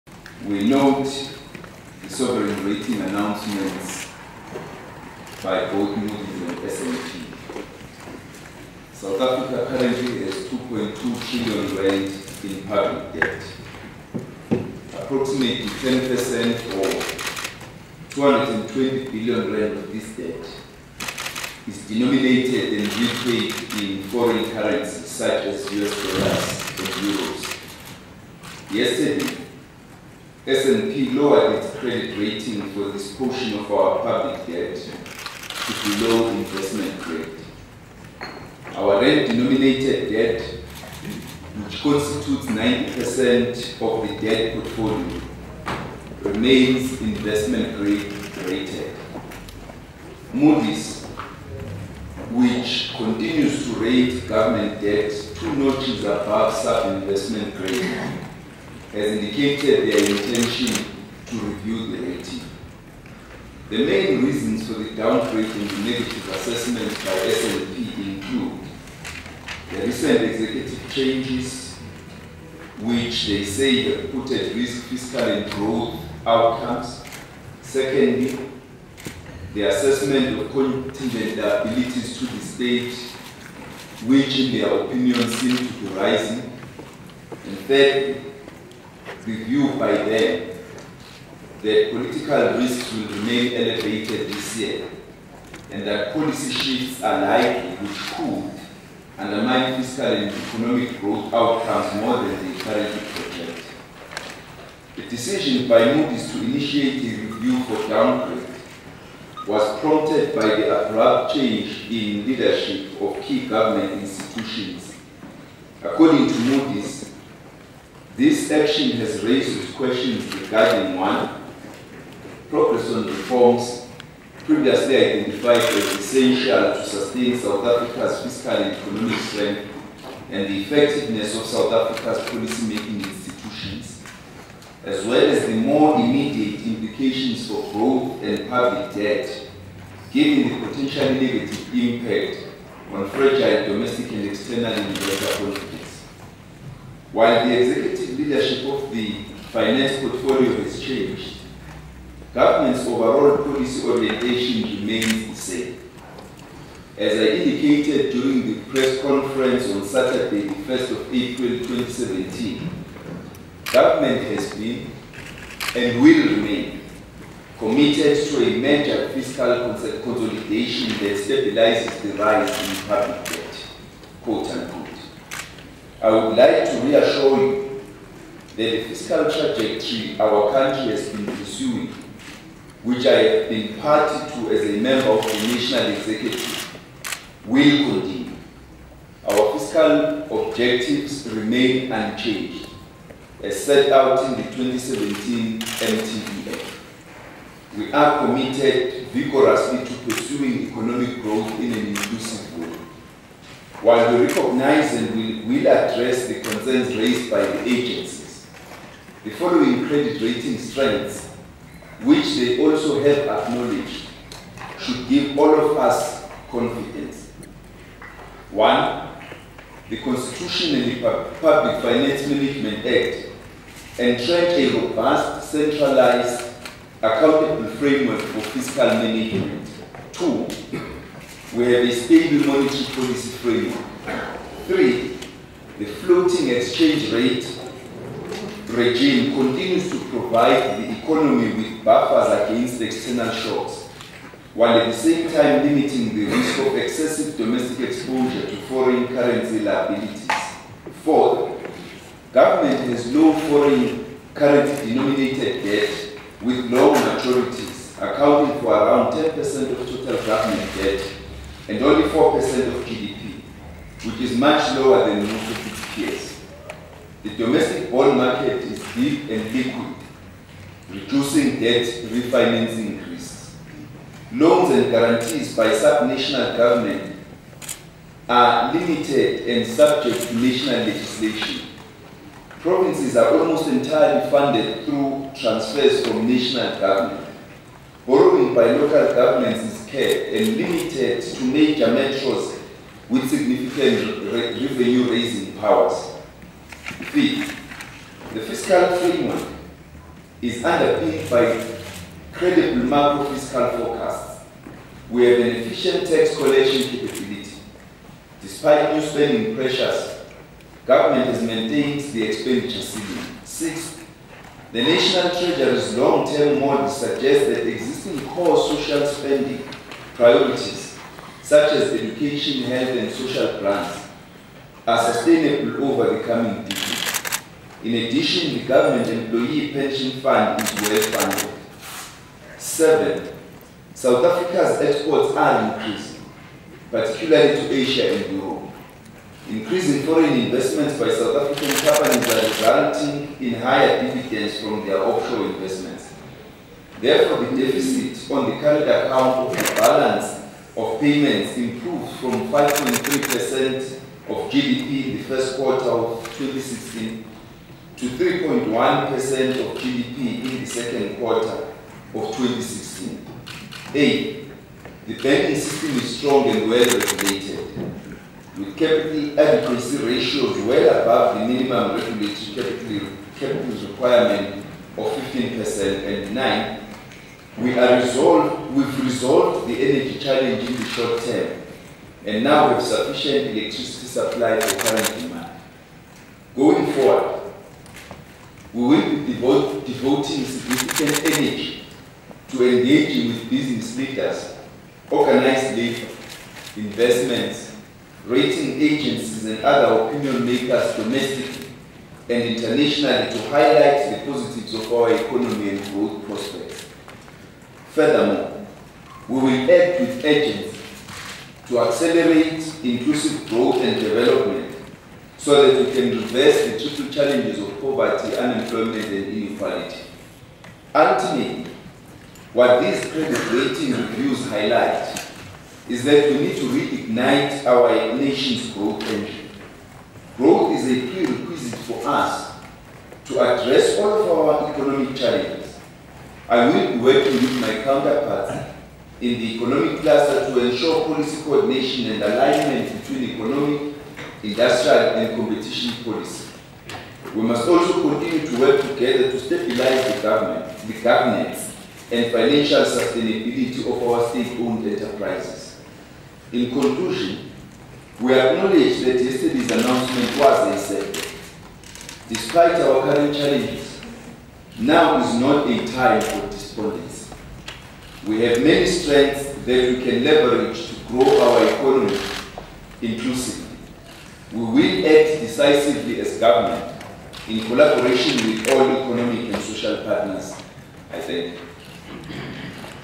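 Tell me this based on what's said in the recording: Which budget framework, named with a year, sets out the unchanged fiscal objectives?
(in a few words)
2017 MTBF.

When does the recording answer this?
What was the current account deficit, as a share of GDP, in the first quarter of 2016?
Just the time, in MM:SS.
05:52.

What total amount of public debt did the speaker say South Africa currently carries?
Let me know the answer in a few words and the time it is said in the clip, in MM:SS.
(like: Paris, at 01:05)
2.2 trillion rand, at 00:10.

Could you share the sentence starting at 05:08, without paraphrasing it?
Despite new spending pressures, government has maintained the expenditure ceiling.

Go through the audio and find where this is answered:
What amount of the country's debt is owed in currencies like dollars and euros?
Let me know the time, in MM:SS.
00:18.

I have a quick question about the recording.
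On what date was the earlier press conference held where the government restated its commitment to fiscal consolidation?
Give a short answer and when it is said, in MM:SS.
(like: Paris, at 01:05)
1 April 2017, at 02:40.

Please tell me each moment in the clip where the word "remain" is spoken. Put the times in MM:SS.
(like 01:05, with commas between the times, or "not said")
00:46, 01:33, 02:34, 02:46, 03:11.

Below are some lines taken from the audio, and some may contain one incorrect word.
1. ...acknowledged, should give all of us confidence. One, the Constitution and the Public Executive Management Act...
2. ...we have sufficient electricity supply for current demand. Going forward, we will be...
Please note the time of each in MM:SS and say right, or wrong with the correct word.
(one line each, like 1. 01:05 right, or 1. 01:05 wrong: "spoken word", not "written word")
1. 03:33 wrong: "Finance", not "Executive"
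2. 06:22 right.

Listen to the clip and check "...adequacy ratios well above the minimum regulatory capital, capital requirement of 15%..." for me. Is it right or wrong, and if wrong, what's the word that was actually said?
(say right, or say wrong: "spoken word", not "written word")
right.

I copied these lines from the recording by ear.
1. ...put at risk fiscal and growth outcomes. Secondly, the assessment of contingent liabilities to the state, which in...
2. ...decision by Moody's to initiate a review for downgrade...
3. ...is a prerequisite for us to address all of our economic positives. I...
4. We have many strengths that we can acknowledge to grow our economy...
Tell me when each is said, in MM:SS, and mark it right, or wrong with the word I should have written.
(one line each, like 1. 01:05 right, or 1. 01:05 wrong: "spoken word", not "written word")
1. 01:14 right
2. 01:45 right
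3. 07:10 wrong: "challenges", not "positives"
4. 07:48 wrong: "leverage", not "acknowledge".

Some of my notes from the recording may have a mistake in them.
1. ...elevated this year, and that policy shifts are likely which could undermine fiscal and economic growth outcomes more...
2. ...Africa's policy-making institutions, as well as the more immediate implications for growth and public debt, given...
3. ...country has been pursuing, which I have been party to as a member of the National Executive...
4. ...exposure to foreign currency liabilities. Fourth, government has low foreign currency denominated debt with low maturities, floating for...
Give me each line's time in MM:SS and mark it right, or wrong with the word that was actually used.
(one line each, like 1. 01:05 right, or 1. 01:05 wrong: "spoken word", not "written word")
1. 01:33 right
2. 02:11 right
3. 03:00 right
4. 04:07 wrong: "accounting", not "floating".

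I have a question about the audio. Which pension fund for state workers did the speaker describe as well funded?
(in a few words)
Government Employee Pension Fund.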